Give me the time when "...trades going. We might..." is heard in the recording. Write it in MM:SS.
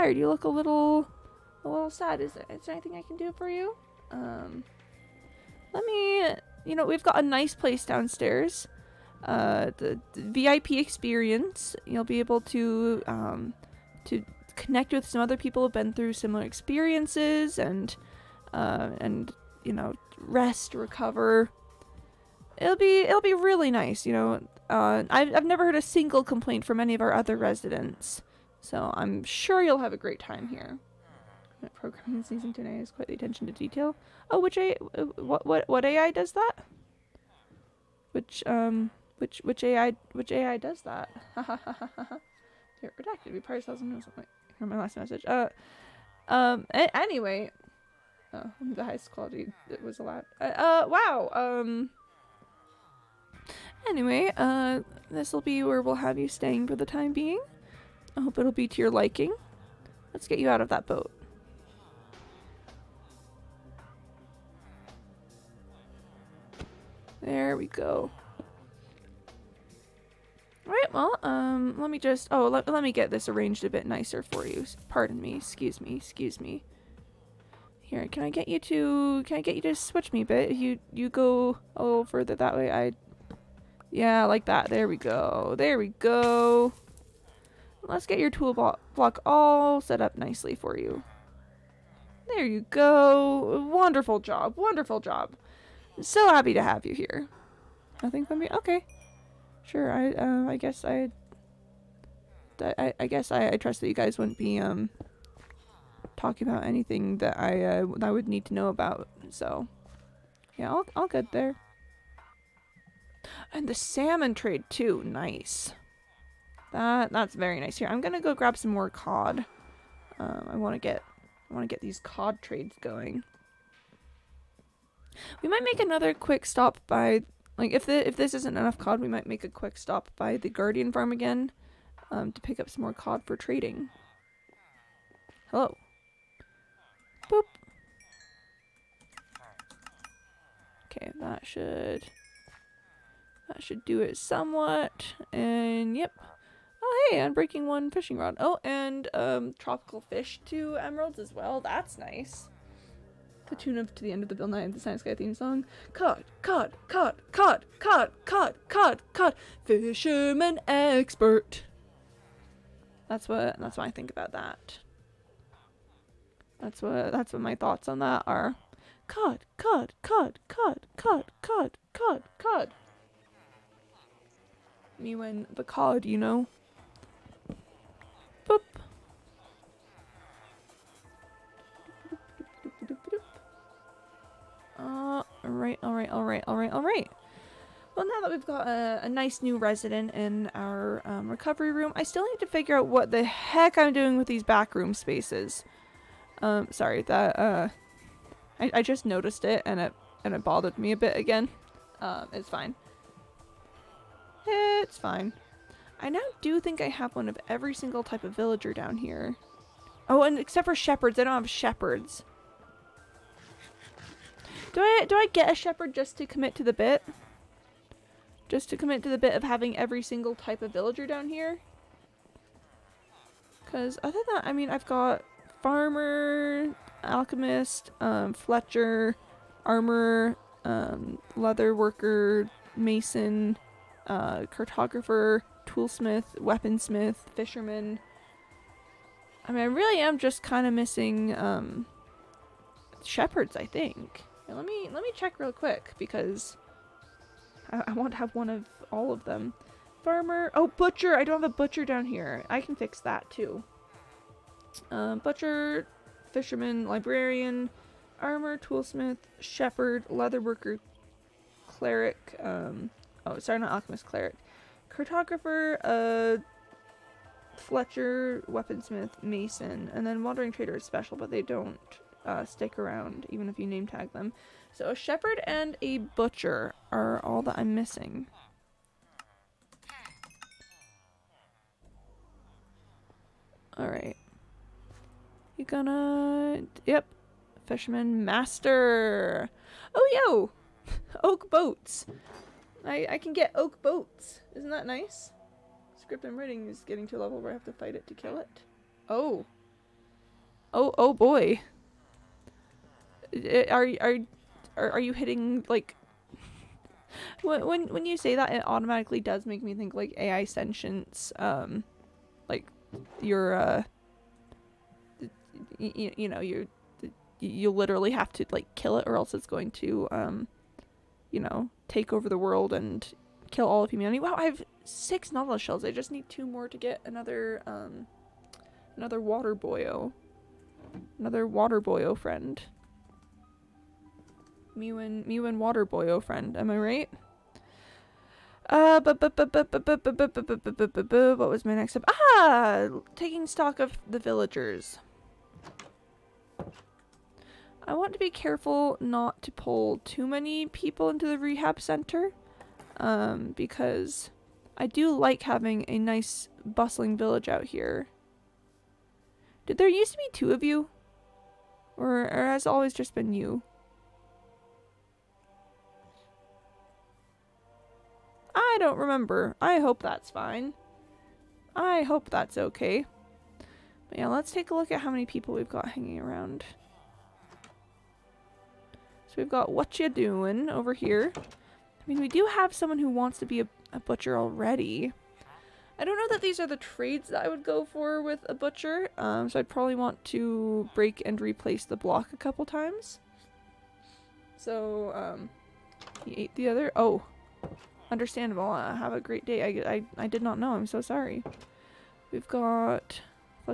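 02:02.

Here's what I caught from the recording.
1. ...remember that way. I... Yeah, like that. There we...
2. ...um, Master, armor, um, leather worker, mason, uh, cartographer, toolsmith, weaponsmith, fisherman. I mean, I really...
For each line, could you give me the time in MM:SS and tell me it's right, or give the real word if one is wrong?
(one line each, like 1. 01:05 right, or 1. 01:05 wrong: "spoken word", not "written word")
1. 01:22 wrong: "further", not "remember"
2. 03:48 wrong: "Fletcher", not "Master".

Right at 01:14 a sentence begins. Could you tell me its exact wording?
Pardon me, excuse me, excuse me.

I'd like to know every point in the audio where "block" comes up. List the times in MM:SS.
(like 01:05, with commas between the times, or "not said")
01:28, 06:31.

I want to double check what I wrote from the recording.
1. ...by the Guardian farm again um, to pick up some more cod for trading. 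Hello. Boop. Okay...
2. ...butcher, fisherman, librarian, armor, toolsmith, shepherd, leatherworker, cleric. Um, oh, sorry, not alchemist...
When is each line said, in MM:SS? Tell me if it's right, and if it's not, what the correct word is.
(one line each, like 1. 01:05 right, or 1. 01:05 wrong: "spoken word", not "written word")
1. 02:10 right
2. 04:15 right.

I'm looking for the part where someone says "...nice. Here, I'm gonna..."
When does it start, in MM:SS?
01:57.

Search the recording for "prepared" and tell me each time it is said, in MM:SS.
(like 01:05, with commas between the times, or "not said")
not said.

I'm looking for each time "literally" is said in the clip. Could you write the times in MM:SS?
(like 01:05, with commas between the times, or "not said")
05:17.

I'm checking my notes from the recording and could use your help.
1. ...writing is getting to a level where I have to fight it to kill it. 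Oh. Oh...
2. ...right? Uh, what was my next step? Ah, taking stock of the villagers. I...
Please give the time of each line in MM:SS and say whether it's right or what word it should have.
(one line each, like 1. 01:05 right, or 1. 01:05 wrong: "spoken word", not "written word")
1. 04:56 right
2. 05:36 right.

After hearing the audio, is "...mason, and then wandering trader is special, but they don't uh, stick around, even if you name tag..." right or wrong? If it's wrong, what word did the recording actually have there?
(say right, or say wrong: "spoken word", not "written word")
right.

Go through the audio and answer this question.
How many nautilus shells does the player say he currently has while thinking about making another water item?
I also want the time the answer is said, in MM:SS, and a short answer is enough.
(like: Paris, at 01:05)
6, at 05:24.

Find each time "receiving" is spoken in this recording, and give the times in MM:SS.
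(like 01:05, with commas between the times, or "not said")
not said.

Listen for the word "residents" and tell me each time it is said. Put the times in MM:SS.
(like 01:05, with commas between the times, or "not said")
00:27, 03:09.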